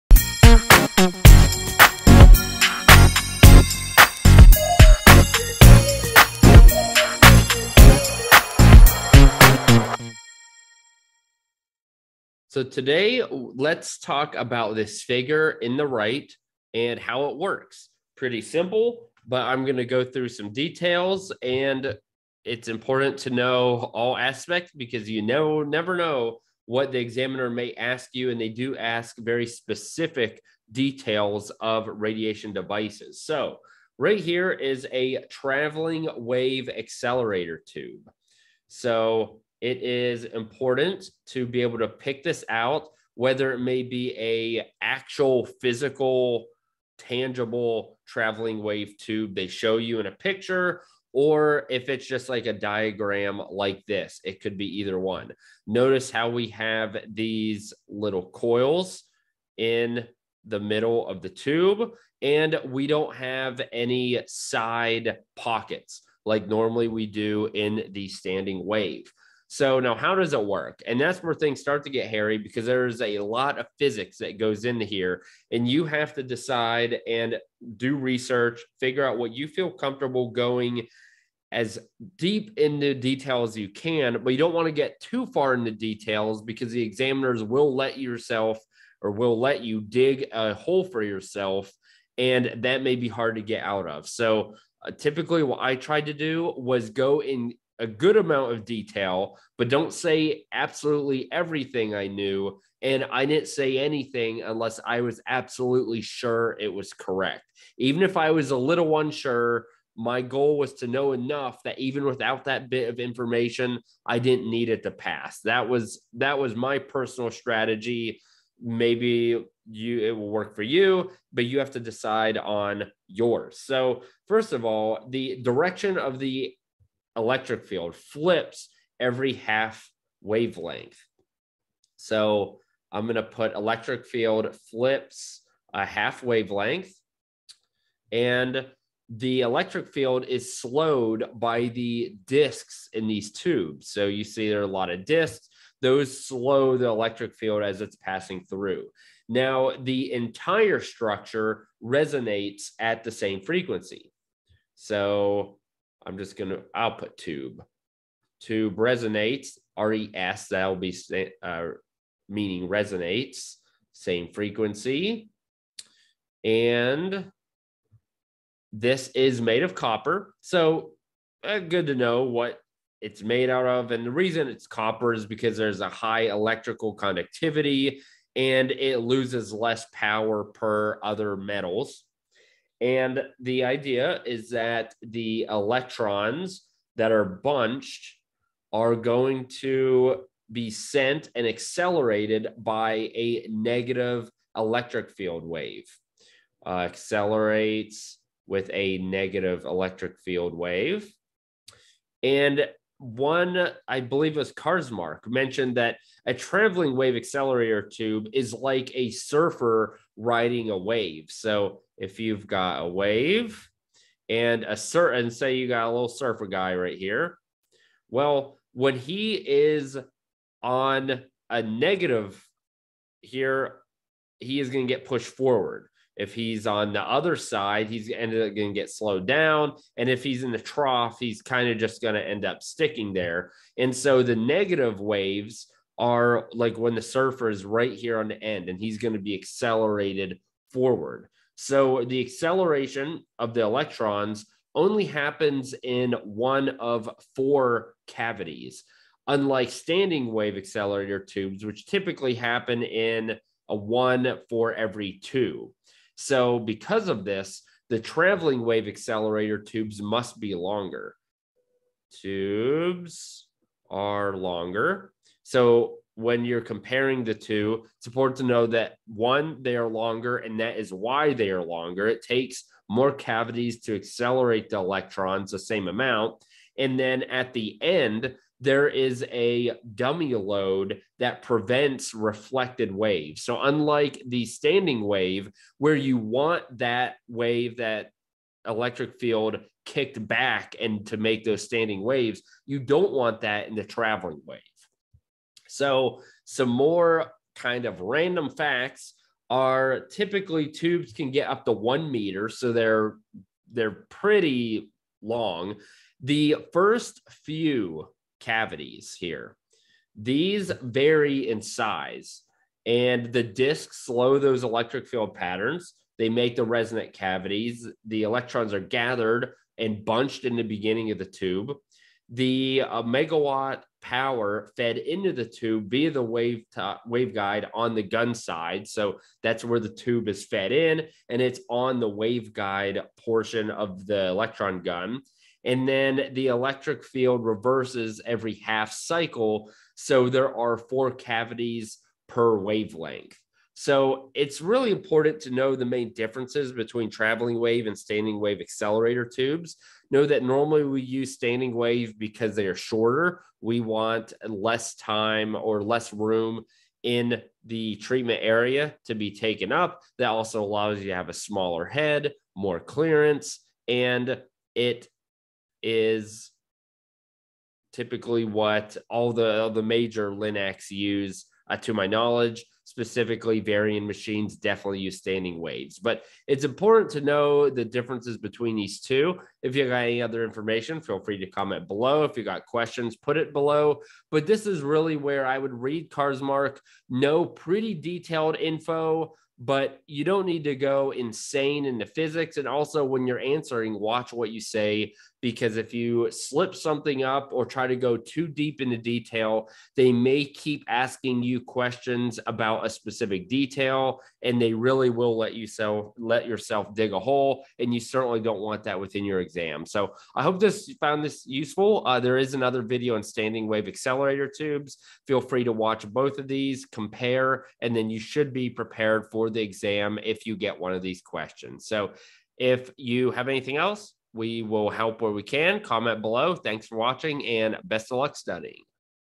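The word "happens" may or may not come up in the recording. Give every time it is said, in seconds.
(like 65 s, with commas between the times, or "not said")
245 s, 252 s.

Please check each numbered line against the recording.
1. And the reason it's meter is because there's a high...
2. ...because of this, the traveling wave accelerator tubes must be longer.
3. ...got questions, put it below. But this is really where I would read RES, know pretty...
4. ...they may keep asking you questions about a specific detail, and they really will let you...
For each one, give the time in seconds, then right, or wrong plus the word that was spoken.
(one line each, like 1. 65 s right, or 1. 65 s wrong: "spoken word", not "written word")
1. 173 s wrong: "copper", not "meter"
2. 256 s right
3. 382 s wrong: "Karzmark", not "RES"
4. 399 s right.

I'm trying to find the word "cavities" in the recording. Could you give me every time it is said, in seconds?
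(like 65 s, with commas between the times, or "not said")
248 s, 273 s, 308 s, 317 s, 341 s.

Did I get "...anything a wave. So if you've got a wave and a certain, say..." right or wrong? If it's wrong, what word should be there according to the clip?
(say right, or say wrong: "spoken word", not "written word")
wrong: "riding", not "anything".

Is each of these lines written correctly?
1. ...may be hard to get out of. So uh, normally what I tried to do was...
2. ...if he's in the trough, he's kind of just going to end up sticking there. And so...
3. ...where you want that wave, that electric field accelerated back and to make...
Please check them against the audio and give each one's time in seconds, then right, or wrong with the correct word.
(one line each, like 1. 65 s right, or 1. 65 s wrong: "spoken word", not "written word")
1. 92 s wrong: "typically", not "normally"
2. 230 s right
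3. 285 s wrong: "kicked", not "accelerated".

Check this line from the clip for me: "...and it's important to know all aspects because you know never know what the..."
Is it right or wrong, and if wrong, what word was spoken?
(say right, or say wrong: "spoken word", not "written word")
right.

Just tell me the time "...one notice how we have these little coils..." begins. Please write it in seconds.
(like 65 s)
54 s.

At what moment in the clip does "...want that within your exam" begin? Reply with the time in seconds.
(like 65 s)
408 s.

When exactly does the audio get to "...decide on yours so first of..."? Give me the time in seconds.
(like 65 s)
121 s.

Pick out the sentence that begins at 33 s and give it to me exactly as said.
So right here is a traveling wave accelerator tube.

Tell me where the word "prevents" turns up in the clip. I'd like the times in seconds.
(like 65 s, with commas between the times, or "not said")
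281 s.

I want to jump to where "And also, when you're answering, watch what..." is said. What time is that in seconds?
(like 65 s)
392 s.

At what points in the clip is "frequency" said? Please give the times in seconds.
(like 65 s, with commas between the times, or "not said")
153 s, 164 s.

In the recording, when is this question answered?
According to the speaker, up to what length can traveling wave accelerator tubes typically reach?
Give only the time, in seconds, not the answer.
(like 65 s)
301 s.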